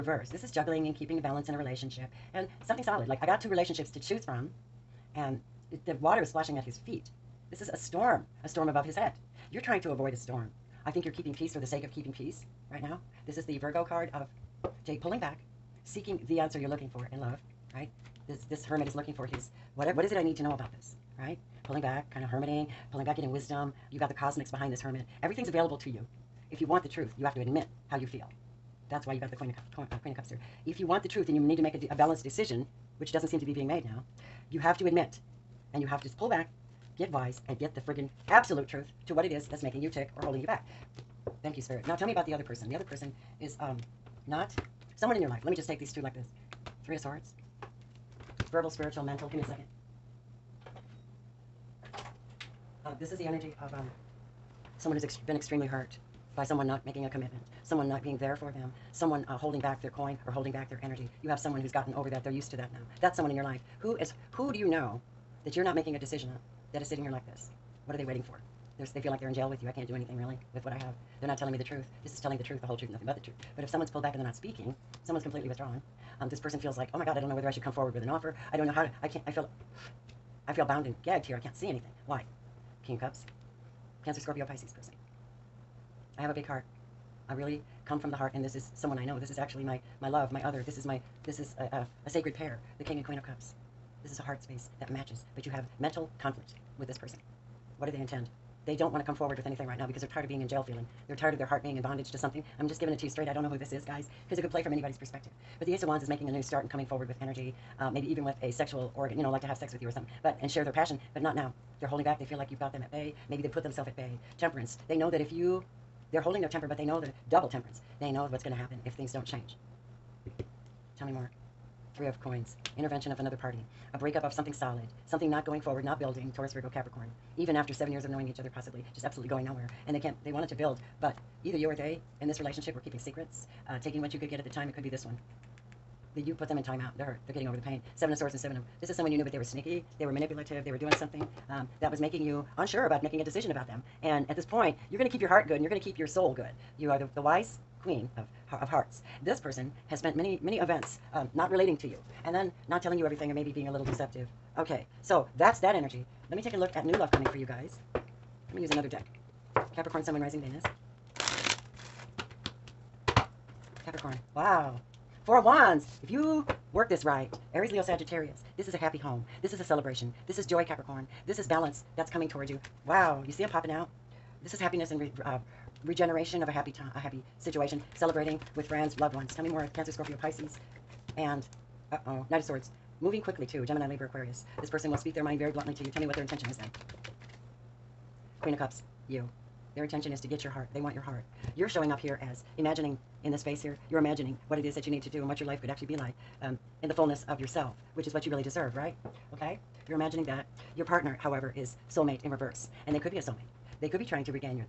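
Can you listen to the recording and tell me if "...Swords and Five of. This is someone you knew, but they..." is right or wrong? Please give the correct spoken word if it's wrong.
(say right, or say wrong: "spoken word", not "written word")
wrong: "Seven", not "Five".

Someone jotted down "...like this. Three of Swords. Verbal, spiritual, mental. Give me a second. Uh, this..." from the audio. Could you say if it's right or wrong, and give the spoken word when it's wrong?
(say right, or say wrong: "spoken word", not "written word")
right.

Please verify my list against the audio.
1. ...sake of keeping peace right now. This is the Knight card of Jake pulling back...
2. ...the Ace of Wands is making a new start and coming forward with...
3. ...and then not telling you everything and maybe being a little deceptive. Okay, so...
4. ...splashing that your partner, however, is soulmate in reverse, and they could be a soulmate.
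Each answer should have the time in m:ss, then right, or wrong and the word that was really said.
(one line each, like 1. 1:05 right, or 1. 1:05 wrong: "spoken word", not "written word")
1. 0:11 wrong: "Virgo", not "Knight"
2. 1:45 right
3. 2:32 right
4. 3:19 wrong: "imagining", not "splashing".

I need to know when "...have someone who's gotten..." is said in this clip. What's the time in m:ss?
1:01.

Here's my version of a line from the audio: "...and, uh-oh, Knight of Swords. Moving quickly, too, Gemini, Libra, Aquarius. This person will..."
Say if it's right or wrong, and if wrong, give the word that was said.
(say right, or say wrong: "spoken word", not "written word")
right.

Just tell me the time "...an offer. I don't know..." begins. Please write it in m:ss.
1:18.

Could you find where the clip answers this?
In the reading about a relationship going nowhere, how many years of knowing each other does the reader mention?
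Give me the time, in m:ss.
2:07.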